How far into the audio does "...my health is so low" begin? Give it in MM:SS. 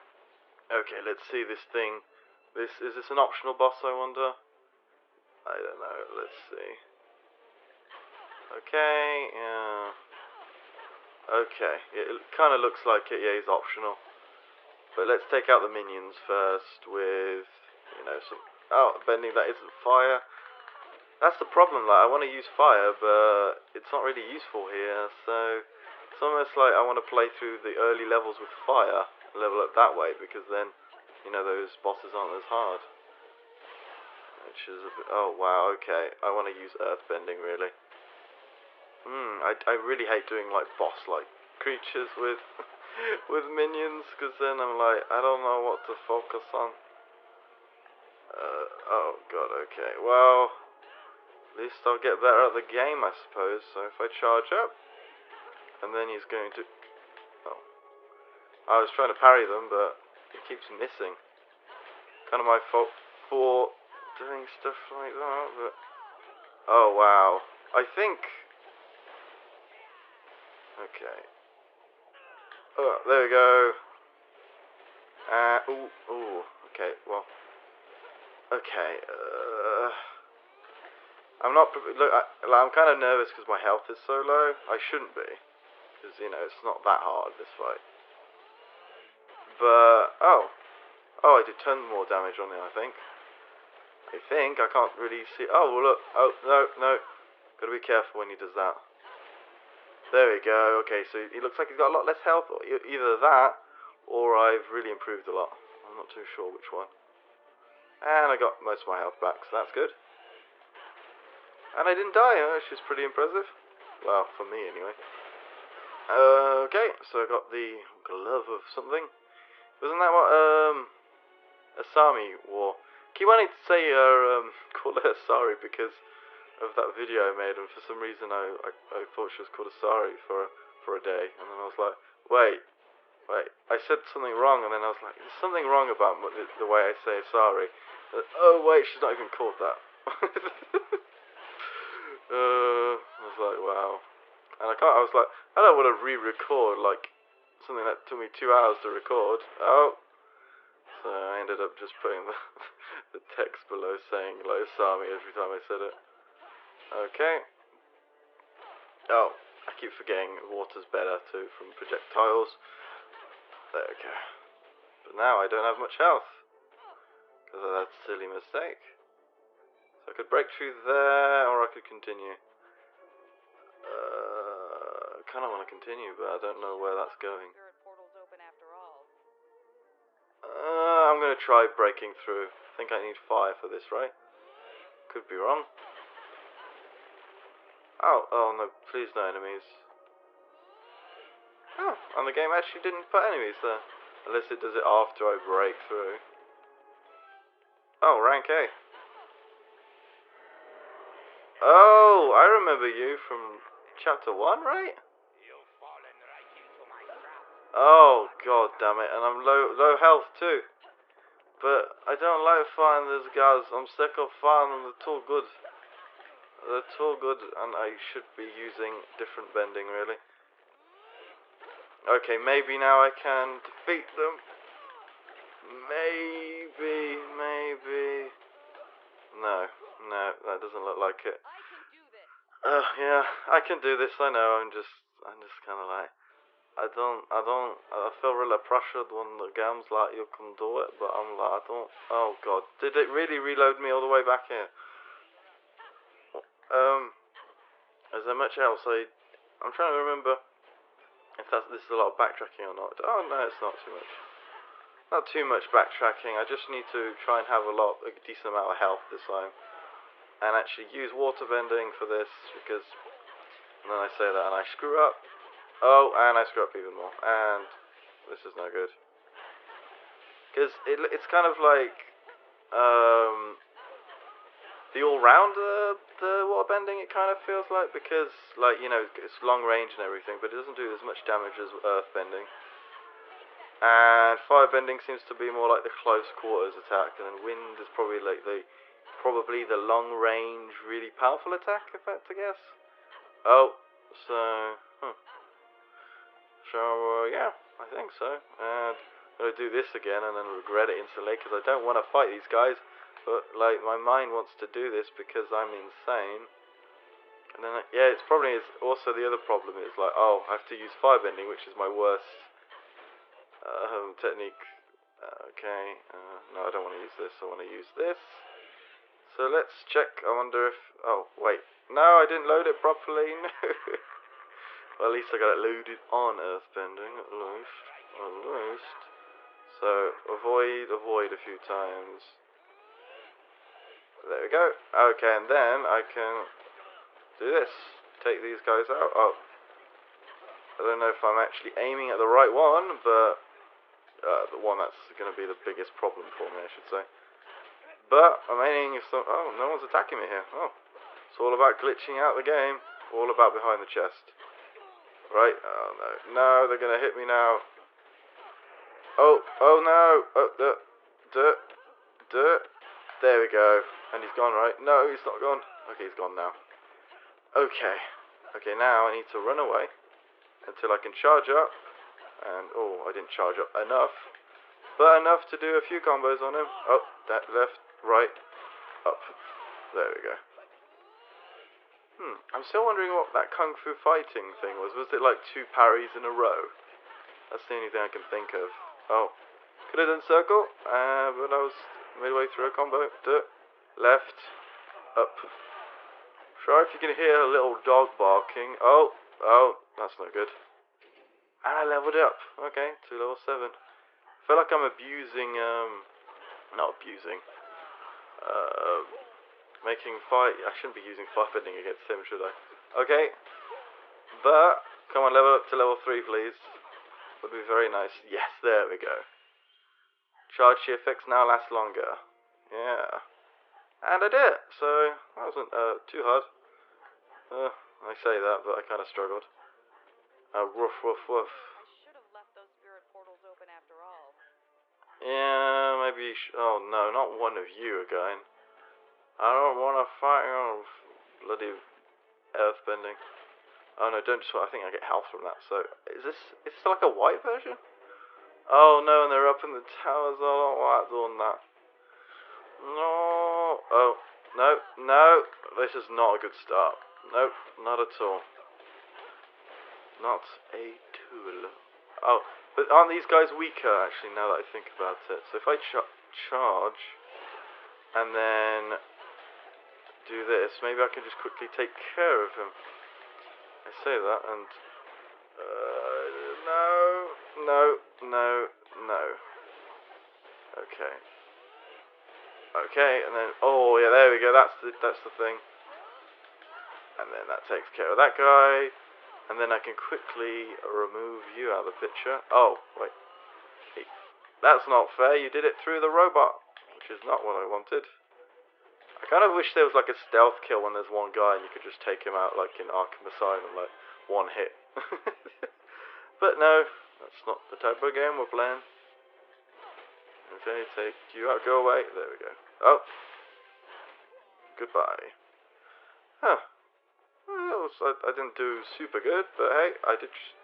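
01:23.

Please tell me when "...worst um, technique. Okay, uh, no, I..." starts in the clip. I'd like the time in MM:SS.
05:11.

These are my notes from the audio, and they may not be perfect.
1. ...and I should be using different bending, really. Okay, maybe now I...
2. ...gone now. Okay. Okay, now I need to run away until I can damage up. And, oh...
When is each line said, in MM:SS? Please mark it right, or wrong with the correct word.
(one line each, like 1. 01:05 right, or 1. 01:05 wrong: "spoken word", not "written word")
1. 03:37 right
2. 06:06 wrong: "charge", not "damage".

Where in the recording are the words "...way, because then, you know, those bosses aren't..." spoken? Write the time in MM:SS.
00:29.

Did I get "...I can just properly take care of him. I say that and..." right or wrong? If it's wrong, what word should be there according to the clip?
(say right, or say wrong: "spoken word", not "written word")
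wrong: "quickly", not "properly".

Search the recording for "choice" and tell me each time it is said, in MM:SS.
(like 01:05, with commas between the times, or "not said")
not said.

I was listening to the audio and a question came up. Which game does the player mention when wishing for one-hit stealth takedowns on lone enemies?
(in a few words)
Arkham Asylum.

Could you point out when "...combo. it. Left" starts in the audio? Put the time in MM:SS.
06:32.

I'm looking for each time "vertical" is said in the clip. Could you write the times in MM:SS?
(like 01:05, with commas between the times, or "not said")
not said.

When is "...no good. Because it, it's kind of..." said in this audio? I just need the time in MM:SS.
04:28.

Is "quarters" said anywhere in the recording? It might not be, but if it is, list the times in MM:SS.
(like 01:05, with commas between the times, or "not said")
04:46.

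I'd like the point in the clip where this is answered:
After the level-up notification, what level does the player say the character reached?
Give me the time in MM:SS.
06:43.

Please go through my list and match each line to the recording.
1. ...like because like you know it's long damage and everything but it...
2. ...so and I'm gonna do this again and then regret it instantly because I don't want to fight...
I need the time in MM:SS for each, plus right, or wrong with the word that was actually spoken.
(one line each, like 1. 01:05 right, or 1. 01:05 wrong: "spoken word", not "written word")
1. 04:37 wrong: "range", not "damage"
2. 04:58 right.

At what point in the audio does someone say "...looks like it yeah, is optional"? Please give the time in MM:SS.
00:12.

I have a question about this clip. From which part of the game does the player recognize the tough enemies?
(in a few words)
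Chapter 1.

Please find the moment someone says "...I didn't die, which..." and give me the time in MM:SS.
01:51.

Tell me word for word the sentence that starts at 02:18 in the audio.
Like, uh, oh wait, she's not even called that.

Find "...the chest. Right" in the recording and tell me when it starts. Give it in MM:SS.
05:53.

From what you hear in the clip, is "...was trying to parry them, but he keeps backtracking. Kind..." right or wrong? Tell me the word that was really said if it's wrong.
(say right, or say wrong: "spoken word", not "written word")
wrong: "missing", not "backtracking".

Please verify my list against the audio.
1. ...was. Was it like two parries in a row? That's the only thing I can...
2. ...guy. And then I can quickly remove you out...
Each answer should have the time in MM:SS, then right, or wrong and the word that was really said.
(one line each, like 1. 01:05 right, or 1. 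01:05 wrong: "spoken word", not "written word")
1. 06:24 right
2. 08:08 right.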